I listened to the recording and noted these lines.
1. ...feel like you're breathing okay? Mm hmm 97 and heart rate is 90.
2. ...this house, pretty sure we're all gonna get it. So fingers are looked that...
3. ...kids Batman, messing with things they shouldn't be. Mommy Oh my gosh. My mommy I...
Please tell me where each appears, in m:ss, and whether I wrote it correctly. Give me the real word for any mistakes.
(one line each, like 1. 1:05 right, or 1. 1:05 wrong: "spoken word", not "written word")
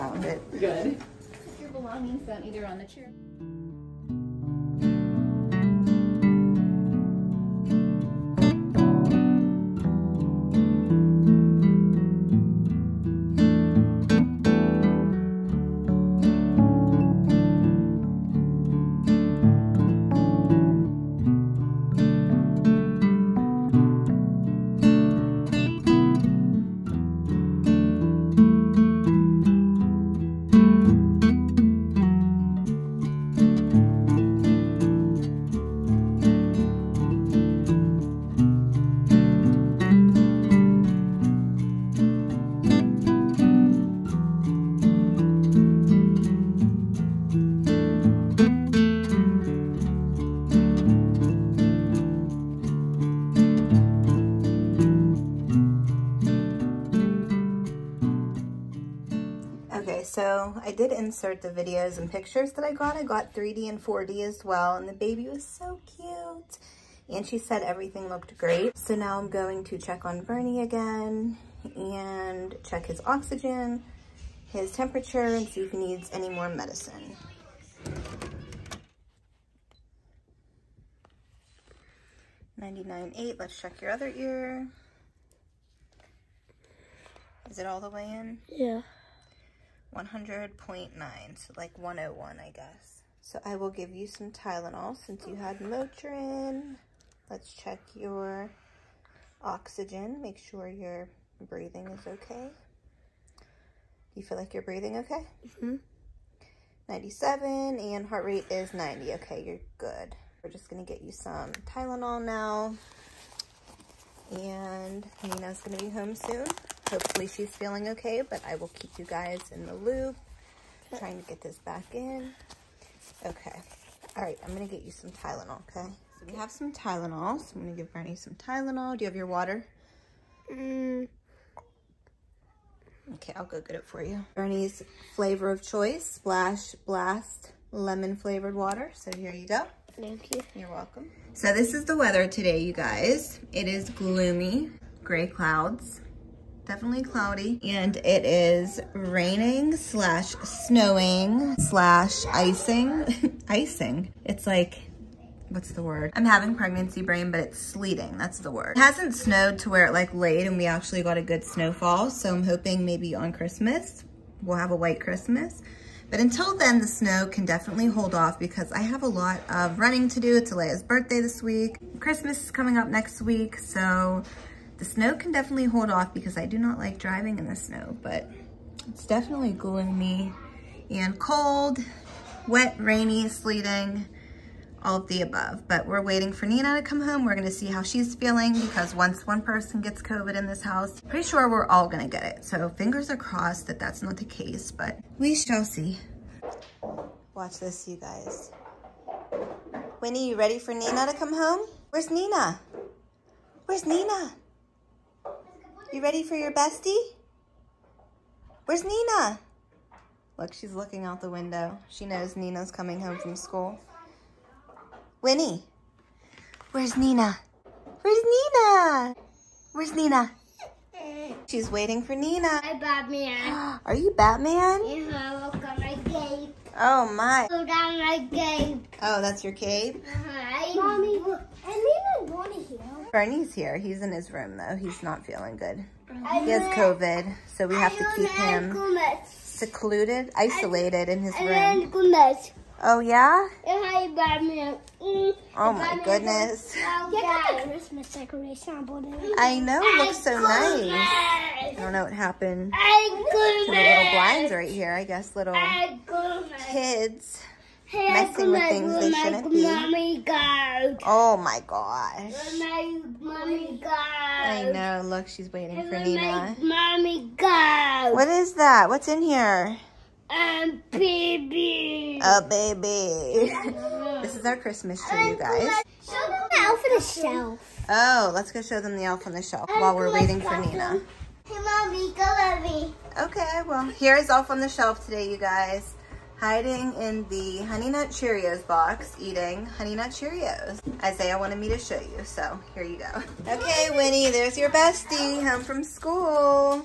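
1. 1:44 right
2. 3:10 wrong: "crossed", not "looked"
3. 4:16 wrong: "Hey", not "Batman".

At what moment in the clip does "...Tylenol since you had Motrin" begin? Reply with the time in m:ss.
1:34.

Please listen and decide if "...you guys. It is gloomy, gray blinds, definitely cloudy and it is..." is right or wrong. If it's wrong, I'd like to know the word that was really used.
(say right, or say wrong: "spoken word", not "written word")
wrong: "clouds", not "blinds".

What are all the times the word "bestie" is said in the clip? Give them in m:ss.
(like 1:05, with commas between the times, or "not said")
3:26, 4:54.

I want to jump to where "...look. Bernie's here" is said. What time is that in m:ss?
3:51.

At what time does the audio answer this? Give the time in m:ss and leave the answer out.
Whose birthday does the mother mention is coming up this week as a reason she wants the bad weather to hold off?
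2:50.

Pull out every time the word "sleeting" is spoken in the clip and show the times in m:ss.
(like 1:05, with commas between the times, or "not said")
2:37, 3:03.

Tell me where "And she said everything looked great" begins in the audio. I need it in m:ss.
1:07.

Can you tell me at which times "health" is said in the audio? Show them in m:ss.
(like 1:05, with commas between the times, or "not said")
not said.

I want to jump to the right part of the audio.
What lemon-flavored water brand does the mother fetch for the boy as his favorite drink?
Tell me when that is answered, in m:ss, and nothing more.
2:16.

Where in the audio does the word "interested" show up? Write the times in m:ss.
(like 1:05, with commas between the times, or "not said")
not said.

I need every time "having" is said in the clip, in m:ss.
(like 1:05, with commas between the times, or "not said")
2:36.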